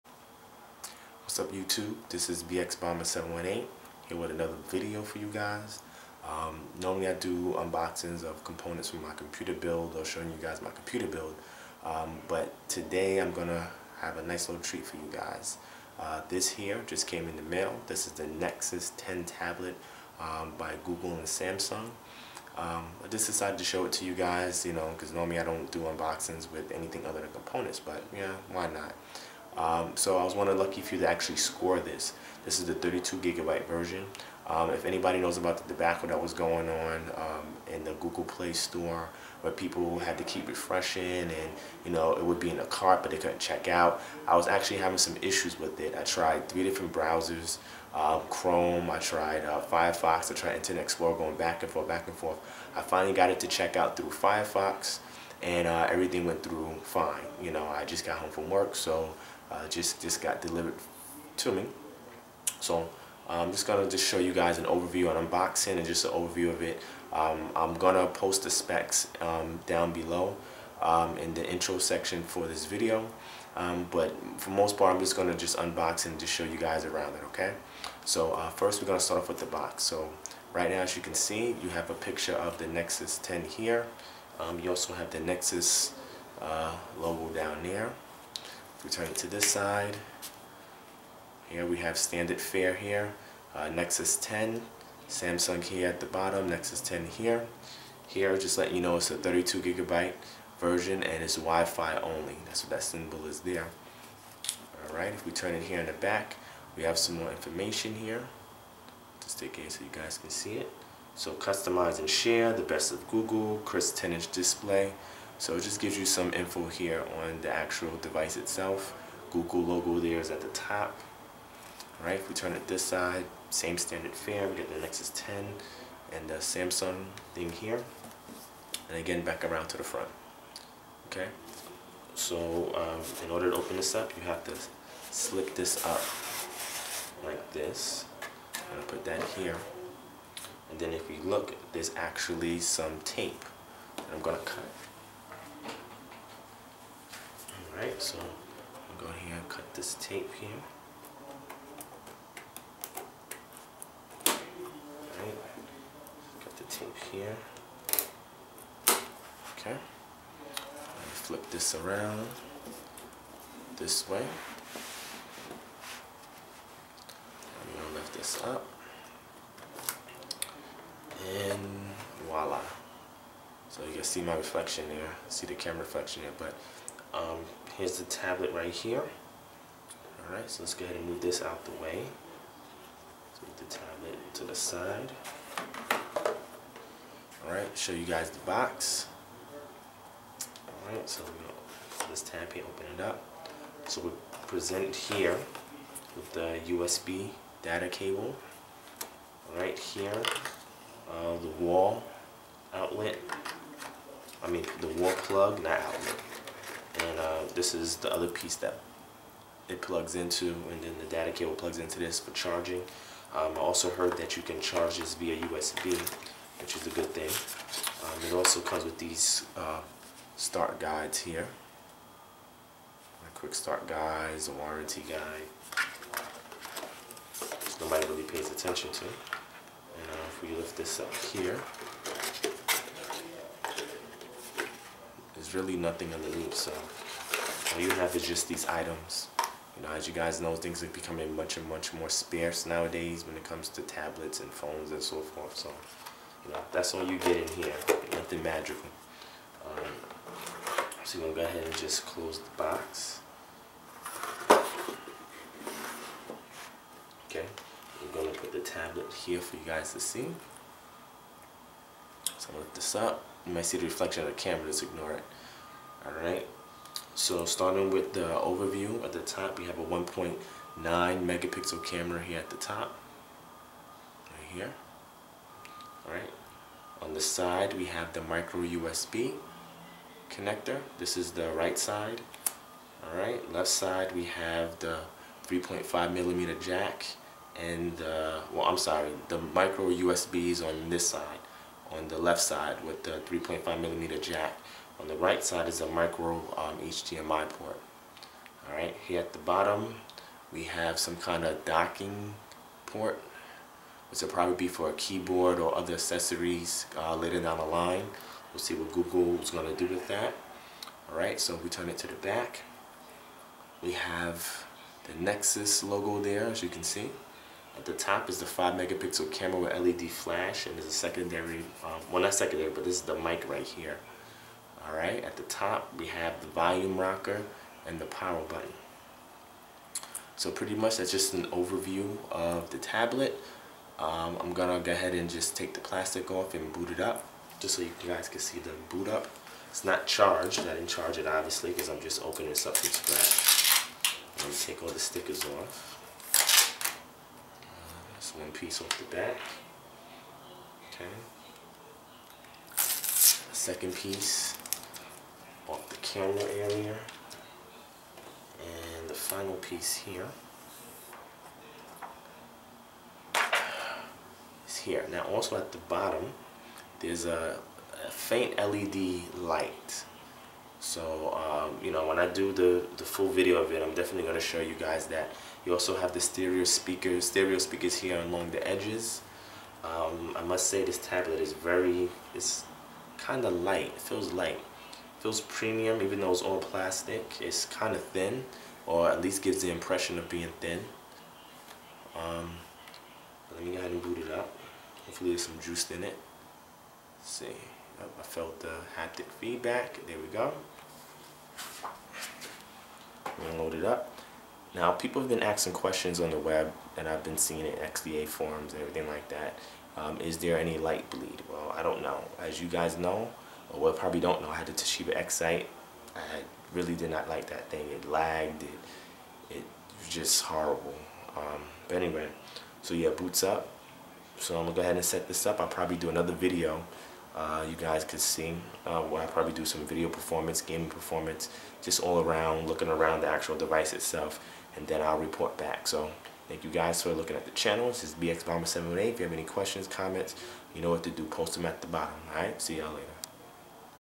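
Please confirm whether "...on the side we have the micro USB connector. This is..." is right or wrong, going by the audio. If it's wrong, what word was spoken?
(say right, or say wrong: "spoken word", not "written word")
right.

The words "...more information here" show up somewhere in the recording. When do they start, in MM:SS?
01:47.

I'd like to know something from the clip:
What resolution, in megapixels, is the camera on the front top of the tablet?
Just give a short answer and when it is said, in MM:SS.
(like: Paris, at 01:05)
1.9 megapixels, at 04:29.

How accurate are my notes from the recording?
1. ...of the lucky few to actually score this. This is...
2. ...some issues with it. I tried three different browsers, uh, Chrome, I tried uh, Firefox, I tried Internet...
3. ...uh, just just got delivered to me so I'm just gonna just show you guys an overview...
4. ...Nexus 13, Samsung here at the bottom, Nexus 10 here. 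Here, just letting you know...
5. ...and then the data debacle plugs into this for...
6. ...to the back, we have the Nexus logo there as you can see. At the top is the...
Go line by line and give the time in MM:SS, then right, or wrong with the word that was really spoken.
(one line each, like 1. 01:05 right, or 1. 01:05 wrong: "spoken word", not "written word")
1. 00:30 right
2. 00:44 right
3. 00:59 right
4. 01:33 wrong: "10", not "13"
5. 03:30 wrong: "cable", not "debacle"
6. 05:11 right.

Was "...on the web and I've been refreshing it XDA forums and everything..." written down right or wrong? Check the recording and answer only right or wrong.
wrong.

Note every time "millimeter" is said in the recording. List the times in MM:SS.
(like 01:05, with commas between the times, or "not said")
04:46, 04:53.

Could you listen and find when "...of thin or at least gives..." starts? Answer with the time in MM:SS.
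06:27.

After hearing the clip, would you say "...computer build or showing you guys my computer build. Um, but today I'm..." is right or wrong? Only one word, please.
right.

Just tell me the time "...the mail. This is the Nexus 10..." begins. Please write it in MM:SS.
00:17.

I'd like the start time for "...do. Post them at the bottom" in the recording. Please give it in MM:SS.
07:21.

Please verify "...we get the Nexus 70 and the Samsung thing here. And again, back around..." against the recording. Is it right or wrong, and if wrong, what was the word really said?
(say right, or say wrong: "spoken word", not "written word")
wrong: "10", not "70".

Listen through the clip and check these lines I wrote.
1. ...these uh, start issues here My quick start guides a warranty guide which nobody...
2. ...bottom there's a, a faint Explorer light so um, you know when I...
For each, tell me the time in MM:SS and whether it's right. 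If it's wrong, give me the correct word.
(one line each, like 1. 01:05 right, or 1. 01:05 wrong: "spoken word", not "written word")
1. 03:38 wrong: "guides", not "issues"
2. 06:05 wrong: "LED", not "Explorer".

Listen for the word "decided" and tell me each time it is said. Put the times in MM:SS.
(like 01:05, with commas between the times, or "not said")
00:23.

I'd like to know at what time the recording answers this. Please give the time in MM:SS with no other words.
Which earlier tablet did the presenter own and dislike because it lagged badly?
06:54.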